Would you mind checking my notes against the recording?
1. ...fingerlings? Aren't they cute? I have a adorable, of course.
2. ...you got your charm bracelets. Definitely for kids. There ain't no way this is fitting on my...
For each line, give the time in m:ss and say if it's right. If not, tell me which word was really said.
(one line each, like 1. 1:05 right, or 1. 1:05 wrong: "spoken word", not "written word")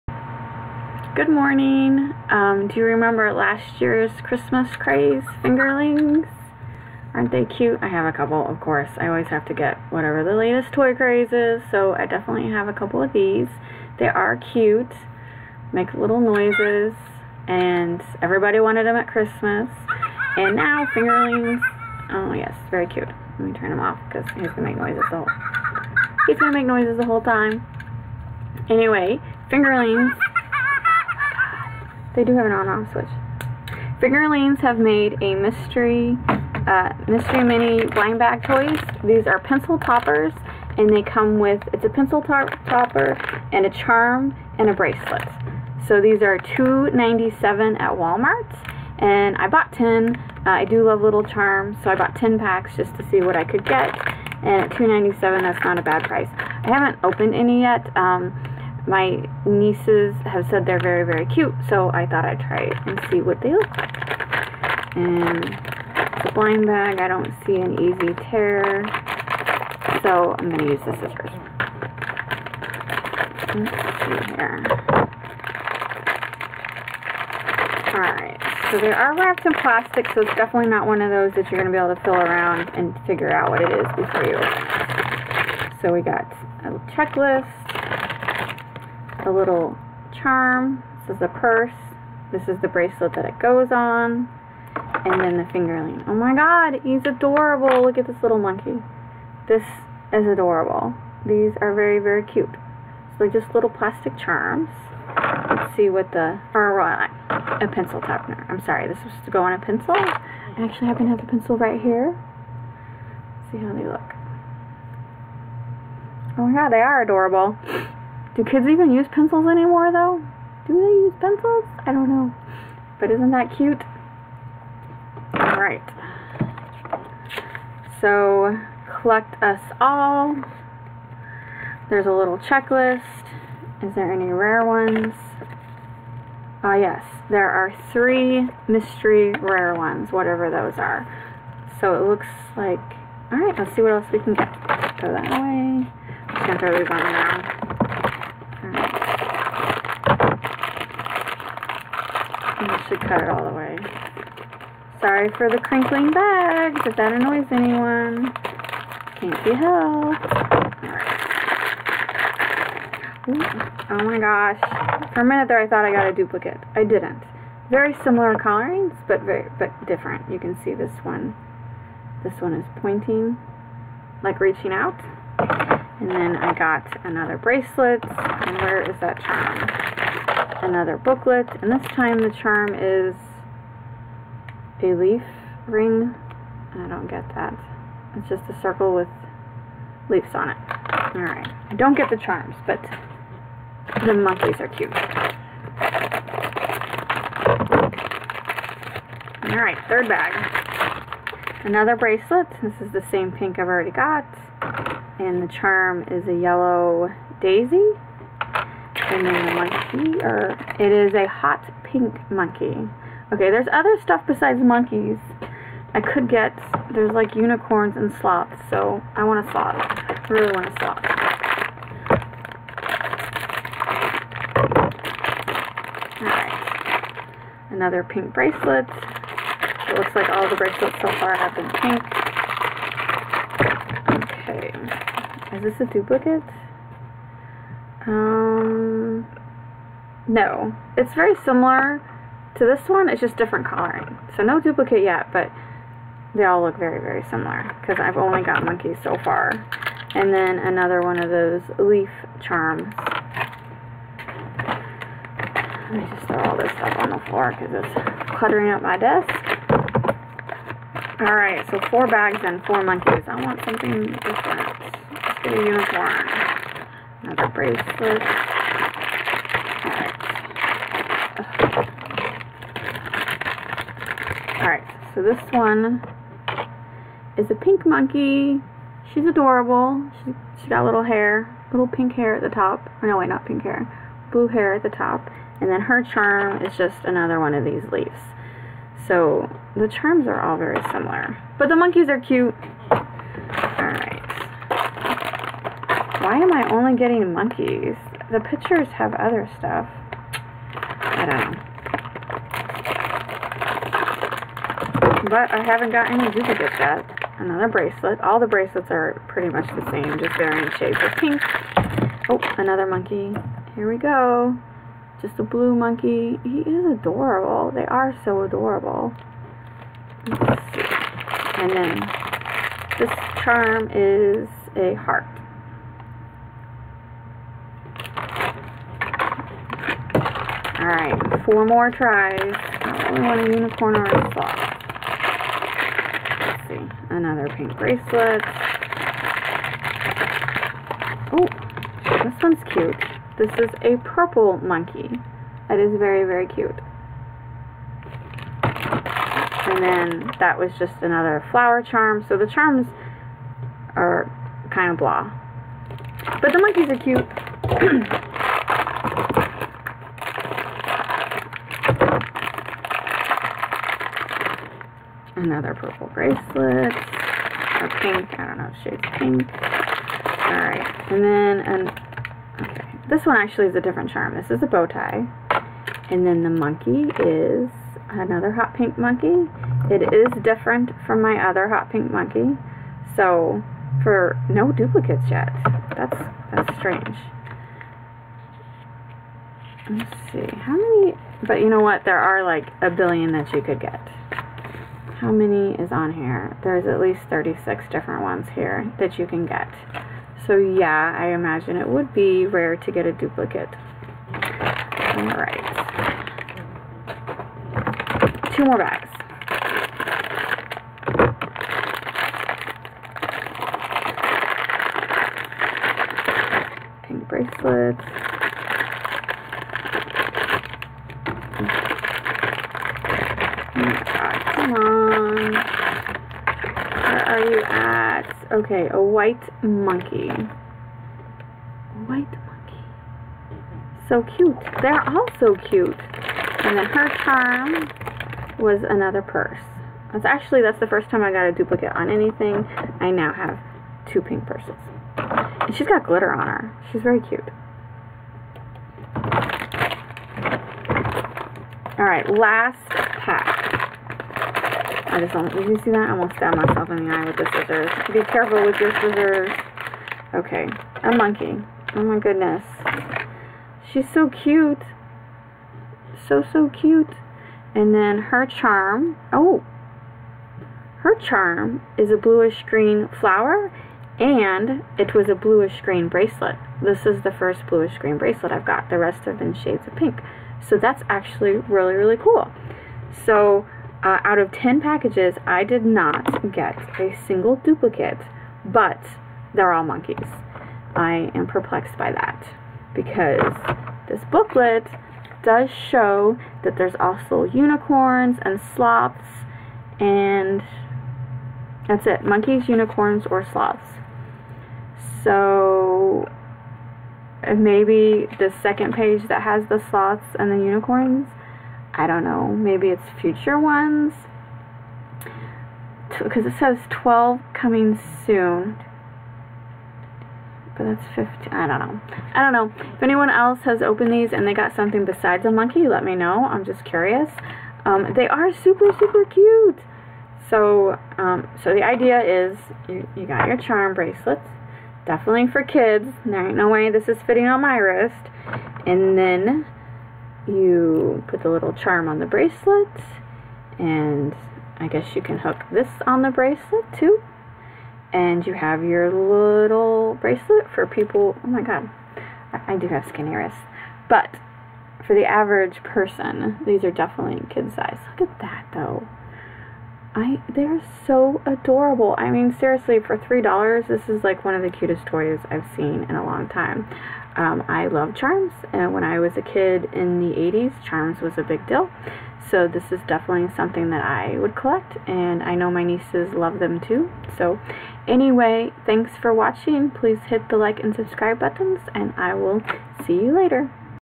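1. 0:05 wrong: "couple", not "adorable"
2. 8:53 right.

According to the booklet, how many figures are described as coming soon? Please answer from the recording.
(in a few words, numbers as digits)
12.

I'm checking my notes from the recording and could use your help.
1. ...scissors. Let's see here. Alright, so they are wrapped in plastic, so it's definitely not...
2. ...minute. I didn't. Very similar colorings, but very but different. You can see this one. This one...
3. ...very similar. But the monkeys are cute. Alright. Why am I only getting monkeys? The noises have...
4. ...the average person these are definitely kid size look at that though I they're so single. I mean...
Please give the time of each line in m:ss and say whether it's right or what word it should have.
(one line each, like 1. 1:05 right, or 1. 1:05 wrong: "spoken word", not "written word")
1. 1:10 right
2. 2:46 wrong: "duplicate", not "minute"
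3. 4:50 wrong: "pictures", not "noises"
4. 9:15 wrong: "adorable", not "single".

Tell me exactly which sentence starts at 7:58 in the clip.
The rest have been shades of pink.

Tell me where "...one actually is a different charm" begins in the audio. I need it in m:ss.
6:13.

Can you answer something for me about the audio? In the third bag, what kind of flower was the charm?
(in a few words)
Yellow daisy.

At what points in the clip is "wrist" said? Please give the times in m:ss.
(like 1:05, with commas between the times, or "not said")
8:57, 9:13.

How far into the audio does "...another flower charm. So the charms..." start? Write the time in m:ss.
5:51.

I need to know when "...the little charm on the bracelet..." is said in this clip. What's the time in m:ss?
9:01.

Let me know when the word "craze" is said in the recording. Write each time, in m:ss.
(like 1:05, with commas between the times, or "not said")
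0:04, 0:10.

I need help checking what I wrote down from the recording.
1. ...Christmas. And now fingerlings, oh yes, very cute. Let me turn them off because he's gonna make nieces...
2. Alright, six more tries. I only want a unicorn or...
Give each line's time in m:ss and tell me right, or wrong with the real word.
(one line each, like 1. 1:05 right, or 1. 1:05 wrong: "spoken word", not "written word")
1. 0:19 wrong: "noises", not "nieces"
2. 5:30 wrong: "four", not "six".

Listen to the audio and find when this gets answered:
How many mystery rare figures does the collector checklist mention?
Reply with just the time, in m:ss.
2:17.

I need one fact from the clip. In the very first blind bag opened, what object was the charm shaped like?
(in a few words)
A purse.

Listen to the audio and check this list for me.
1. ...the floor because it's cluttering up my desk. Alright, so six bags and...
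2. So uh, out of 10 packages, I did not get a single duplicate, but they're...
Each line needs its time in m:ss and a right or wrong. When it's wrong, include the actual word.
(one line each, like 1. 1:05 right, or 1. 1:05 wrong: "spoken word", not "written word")
1. 4:17 wrong: "four", not "six"
2. 8:03 right.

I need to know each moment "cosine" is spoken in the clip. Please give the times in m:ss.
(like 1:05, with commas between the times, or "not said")
not said.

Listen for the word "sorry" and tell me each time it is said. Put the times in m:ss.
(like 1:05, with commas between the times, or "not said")
1:48, 2:34.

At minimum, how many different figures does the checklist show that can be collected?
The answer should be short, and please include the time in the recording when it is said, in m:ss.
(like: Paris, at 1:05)
36, at 6:37.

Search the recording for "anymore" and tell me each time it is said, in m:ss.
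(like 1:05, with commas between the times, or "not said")
1:59.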